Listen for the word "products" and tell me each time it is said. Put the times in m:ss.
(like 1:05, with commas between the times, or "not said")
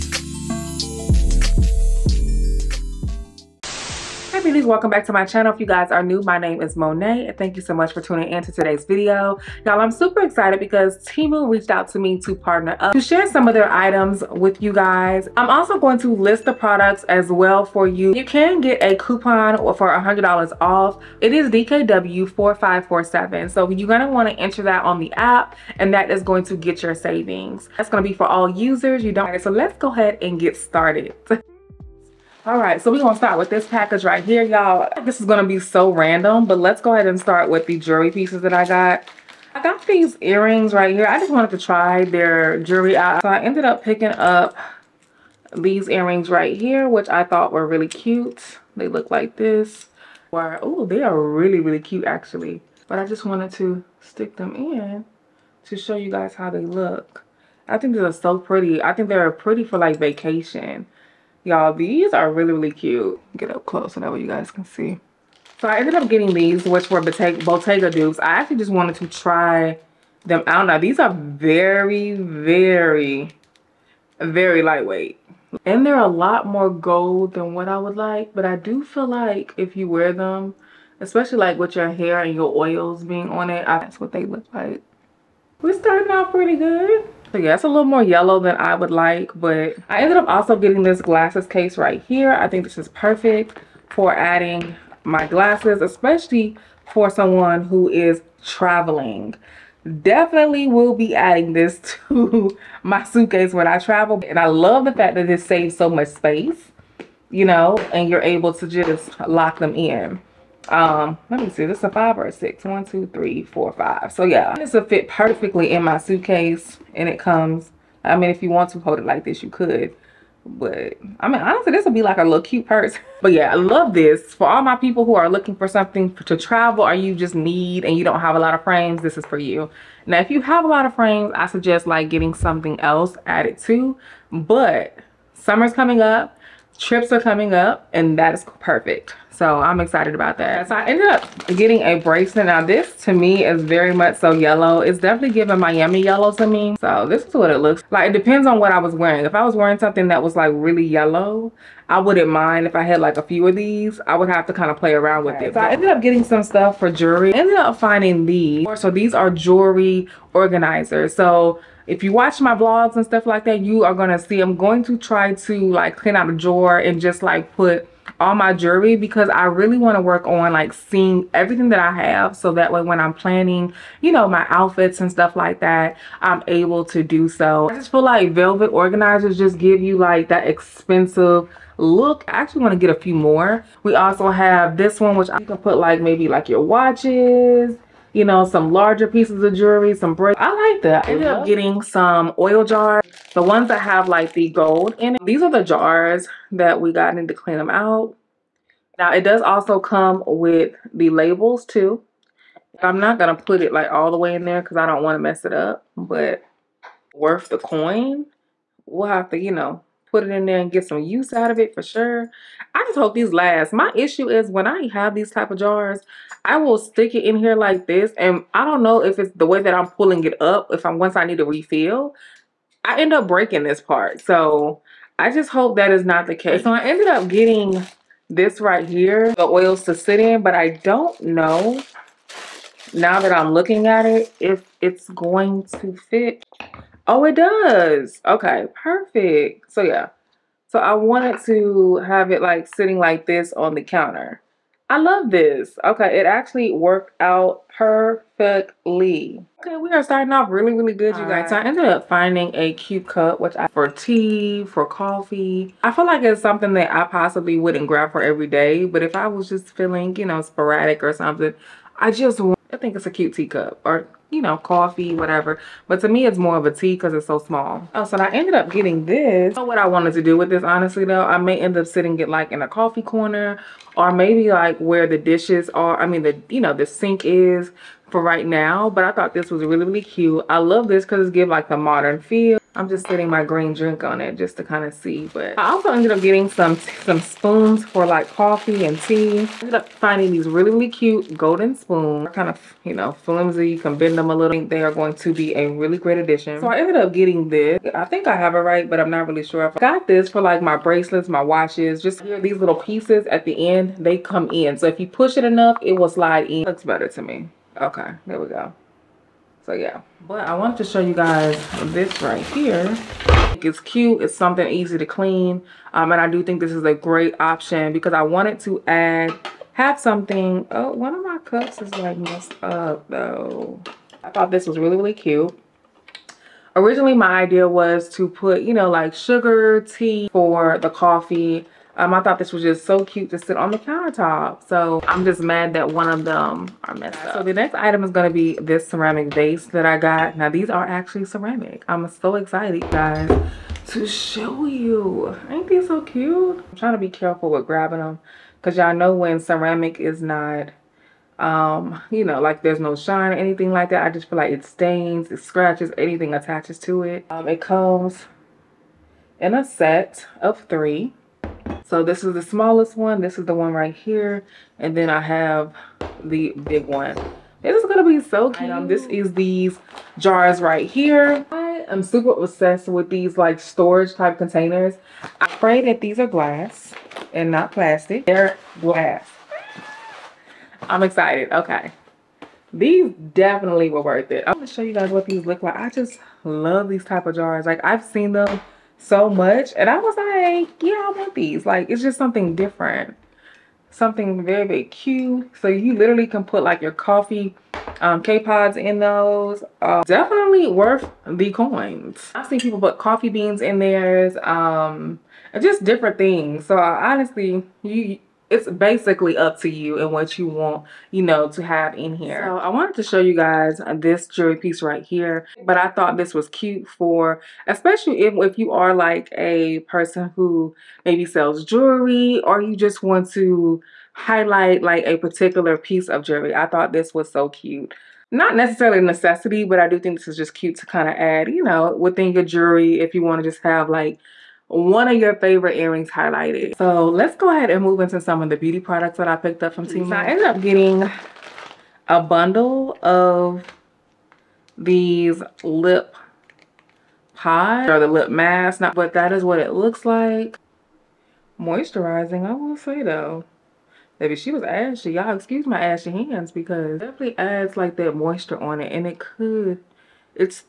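0:16, 7:18.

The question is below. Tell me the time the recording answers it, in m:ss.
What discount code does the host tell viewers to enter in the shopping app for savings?
0:21.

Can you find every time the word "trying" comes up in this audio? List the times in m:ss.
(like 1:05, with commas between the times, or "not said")
5:46.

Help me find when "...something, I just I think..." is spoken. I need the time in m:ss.
4:21.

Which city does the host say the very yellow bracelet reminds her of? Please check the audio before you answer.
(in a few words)
Miami.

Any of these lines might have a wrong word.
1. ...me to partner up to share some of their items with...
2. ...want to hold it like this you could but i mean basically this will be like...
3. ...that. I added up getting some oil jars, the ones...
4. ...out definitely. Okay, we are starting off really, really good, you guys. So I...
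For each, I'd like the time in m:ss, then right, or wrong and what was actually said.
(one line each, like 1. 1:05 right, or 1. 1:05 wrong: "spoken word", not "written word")
1. 0:11 right
2. 1:58 wrong: "honestly", not "basically"
3. 3:10 wrong: "ended", not "added"
4. 4:07 wrong: "perfectly", not "definitely".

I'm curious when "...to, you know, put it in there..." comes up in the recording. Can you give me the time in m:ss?
3:29.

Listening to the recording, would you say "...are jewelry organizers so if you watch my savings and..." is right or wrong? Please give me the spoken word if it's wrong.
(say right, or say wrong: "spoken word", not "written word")
wrong: "vlogs", not "savings".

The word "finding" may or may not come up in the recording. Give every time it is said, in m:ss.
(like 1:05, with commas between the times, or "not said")
2:37, 4:12, 4:49.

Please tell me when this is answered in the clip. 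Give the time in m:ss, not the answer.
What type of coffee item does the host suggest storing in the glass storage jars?
6:38.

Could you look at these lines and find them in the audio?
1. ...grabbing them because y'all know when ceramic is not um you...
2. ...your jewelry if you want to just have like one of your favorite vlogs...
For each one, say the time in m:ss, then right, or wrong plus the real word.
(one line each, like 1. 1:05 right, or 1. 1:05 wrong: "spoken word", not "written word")
1. 5:47 right
2. 7:12 wrong: "earrings", not "vlogs".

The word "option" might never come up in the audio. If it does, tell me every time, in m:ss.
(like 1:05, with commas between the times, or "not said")
5:17.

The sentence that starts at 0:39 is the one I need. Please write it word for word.
I got these earrings right here.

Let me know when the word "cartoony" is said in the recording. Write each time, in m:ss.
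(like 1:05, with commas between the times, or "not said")
not said.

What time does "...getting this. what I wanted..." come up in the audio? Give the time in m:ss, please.
4:28.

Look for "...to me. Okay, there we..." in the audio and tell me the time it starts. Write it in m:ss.
5:07.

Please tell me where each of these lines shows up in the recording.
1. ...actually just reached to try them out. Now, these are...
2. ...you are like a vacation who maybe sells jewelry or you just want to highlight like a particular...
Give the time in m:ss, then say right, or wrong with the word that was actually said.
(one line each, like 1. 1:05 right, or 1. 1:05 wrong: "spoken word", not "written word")
1. 1:08 wrong: "wanted", not "reached"
2. 6:58 wrong: "person", not "vacation".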